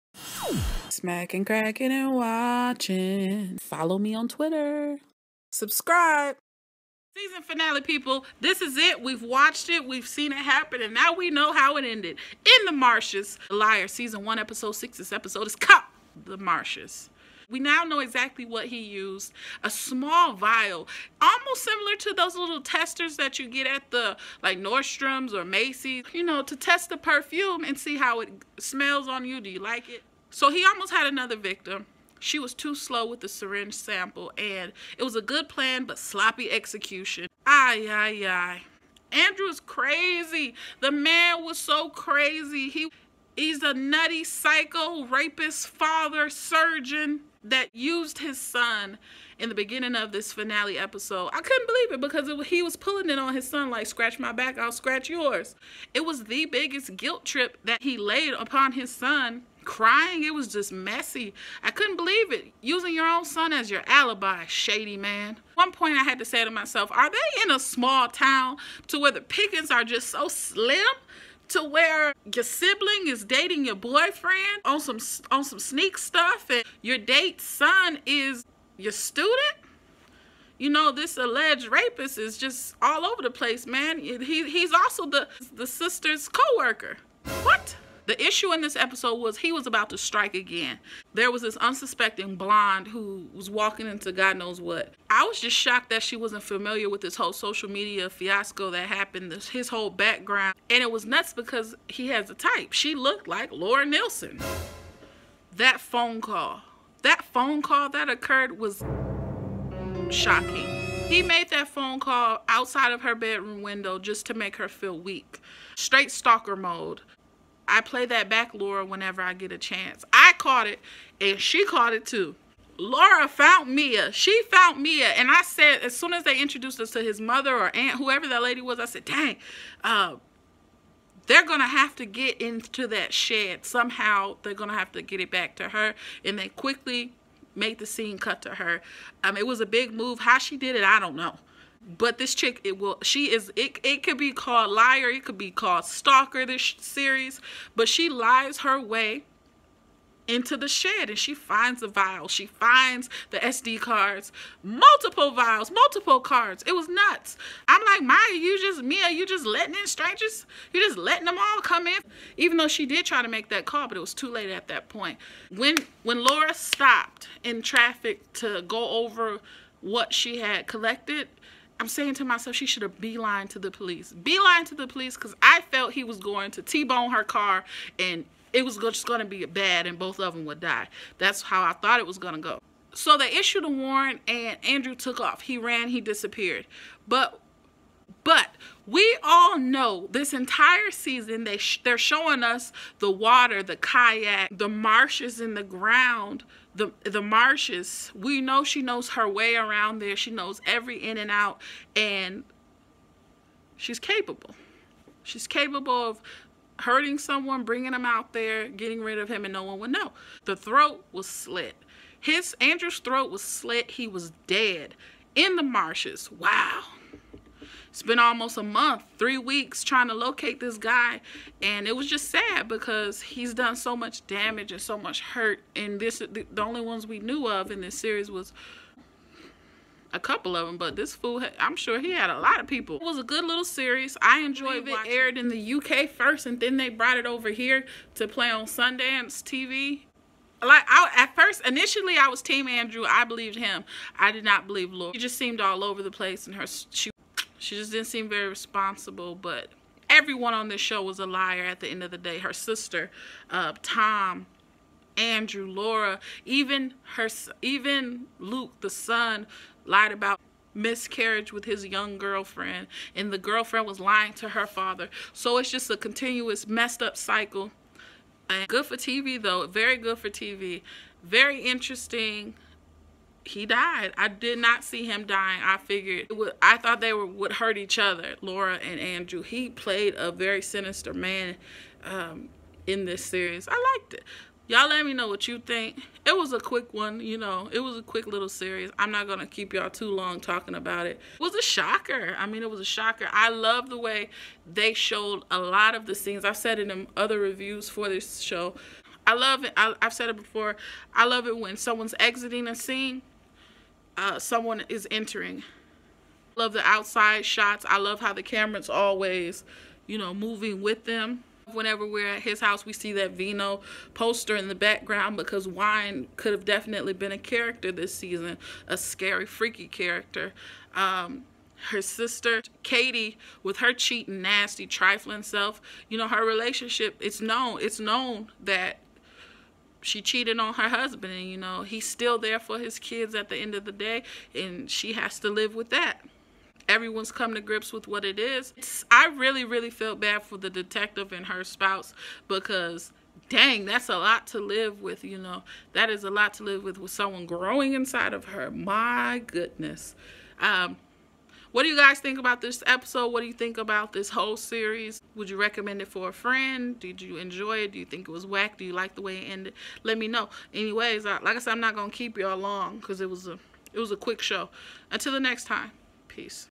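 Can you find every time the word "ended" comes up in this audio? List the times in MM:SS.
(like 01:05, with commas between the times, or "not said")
00:11, 05:59.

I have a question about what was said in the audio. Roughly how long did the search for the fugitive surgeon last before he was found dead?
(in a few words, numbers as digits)
3 weeks.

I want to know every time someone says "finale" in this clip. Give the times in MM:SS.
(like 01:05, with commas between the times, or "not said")
00:07, 00:50.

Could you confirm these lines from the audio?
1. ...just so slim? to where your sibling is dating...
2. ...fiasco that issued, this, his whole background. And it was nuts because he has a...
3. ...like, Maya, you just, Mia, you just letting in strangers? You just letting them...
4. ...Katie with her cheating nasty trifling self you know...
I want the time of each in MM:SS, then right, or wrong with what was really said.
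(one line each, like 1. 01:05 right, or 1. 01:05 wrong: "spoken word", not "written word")
1. 01:09 right
2. 01:38 wrong: "happened", not "issued"
3. 02:37 right
4. 05:22 right.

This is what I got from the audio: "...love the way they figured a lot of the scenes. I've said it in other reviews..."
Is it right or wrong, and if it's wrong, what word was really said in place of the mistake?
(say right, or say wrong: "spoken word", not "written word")
wrong: "showed", not "figured".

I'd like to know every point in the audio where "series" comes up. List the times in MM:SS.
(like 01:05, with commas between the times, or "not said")
02:26, 03:47, 03:53, 04:43, 04:48, 05:54.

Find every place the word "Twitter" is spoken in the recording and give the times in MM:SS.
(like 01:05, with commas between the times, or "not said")
00:04.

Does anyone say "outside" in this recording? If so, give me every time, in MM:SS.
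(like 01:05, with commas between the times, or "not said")
01:52, 05:06.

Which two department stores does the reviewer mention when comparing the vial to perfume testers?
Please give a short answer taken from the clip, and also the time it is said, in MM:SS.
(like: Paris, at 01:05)
Nordstrom's or Macy's, at 00:24.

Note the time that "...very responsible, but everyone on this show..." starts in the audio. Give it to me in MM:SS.
04:08.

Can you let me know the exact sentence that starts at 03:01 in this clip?
That's how I thought it was going to go.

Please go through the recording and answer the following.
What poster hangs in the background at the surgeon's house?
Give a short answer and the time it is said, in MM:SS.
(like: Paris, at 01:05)
Vino poster, at 05:13.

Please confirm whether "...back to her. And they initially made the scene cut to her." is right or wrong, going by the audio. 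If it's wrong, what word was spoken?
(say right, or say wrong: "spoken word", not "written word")
wrong: "quickly", not "initially".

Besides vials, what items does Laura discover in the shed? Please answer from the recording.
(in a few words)
SD cards.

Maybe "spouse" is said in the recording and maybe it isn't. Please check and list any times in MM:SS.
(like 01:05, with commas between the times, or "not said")
05:41.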